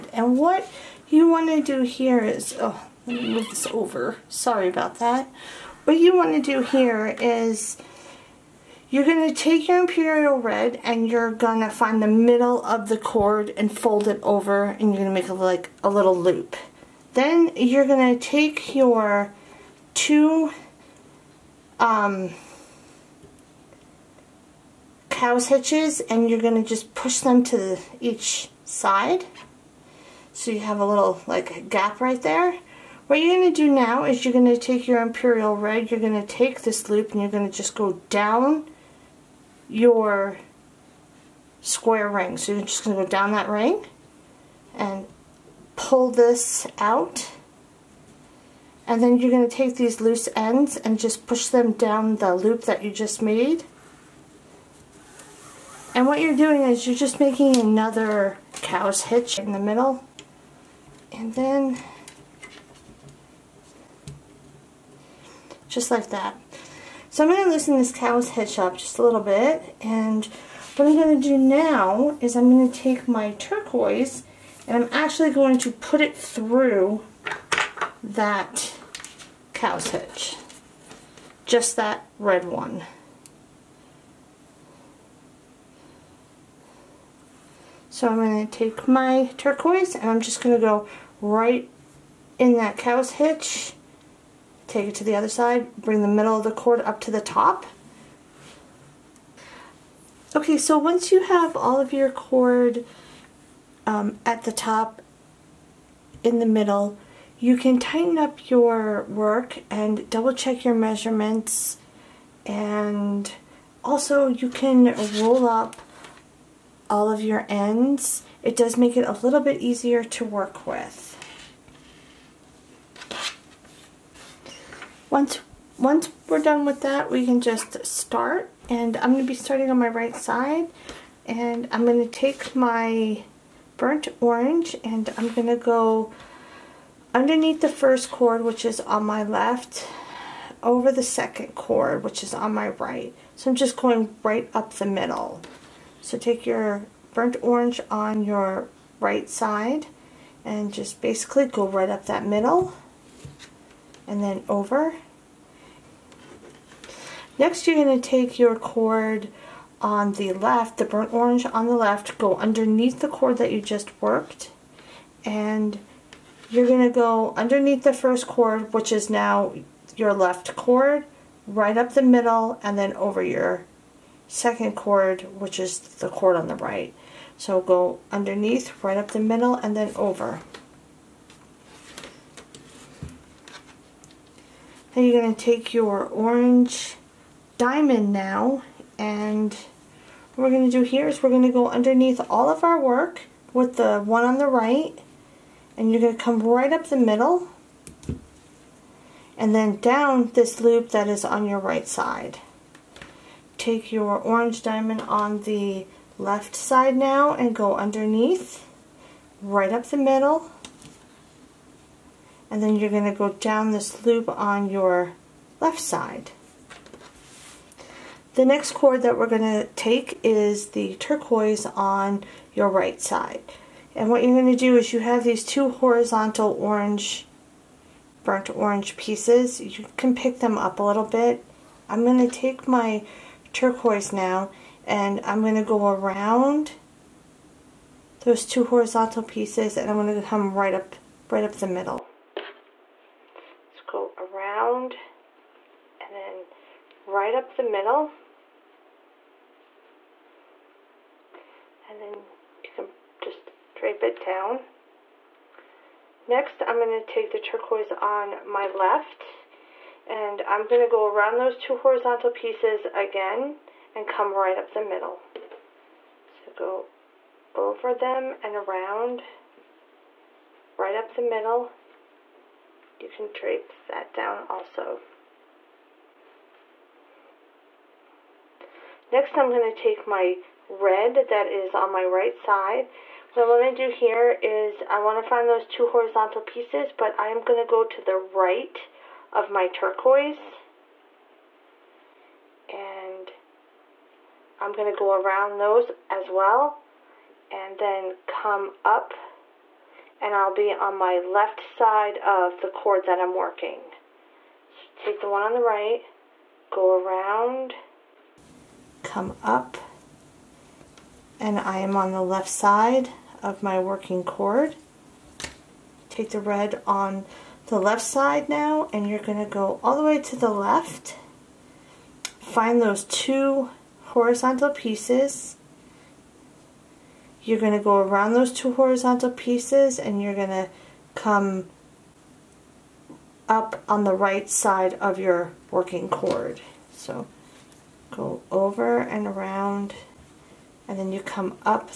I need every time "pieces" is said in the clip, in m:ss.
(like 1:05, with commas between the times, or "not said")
3:48, 3:59, 4:22, 4:46, 5:24, 5:29.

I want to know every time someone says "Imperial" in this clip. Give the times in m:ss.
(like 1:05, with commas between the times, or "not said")
0:09, 0:35.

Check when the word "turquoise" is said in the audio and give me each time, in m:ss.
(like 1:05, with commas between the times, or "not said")
1:13, 1:29, 3:40, 3:53, 4:17, 4:49.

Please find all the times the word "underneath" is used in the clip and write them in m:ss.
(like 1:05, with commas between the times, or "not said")
2:17, 2:42, 2:47, 2:58, 3:11, 3:27.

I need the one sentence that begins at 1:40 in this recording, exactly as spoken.
Okay, so once you have all of your cord um, at the top, in the middle.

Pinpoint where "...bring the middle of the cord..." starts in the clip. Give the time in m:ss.
1:35.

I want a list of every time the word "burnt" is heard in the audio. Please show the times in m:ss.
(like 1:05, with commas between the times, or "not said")
2:13, 2:27, 2:40, 3:48.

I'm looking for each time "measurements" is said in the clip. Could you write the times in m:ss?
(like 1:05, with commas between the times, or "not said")
1:50.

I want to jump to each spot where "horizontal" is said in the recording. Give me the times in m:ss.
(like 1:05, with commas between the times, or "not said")
3:45, 3:58, 4:21, 4:45, 5:24, 5:28.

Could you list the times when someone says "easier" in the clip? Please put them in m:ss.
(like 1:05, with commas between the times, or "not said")
1:59.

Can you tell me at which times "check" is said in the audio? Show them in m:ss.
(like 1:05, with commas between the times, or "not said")
1:50.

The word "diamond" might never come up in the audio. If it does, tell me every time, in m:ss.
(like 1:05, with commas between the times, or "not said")
3:07, 3:24.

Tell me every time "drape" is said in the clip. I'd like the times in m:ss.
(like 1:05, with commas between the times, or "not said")
4:13, 4:33.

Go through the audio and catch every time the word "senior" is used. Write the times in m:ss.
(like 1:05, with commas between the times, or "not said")
not said.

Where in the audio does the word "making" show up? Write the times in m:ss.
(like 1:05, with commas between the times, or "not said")
0:57.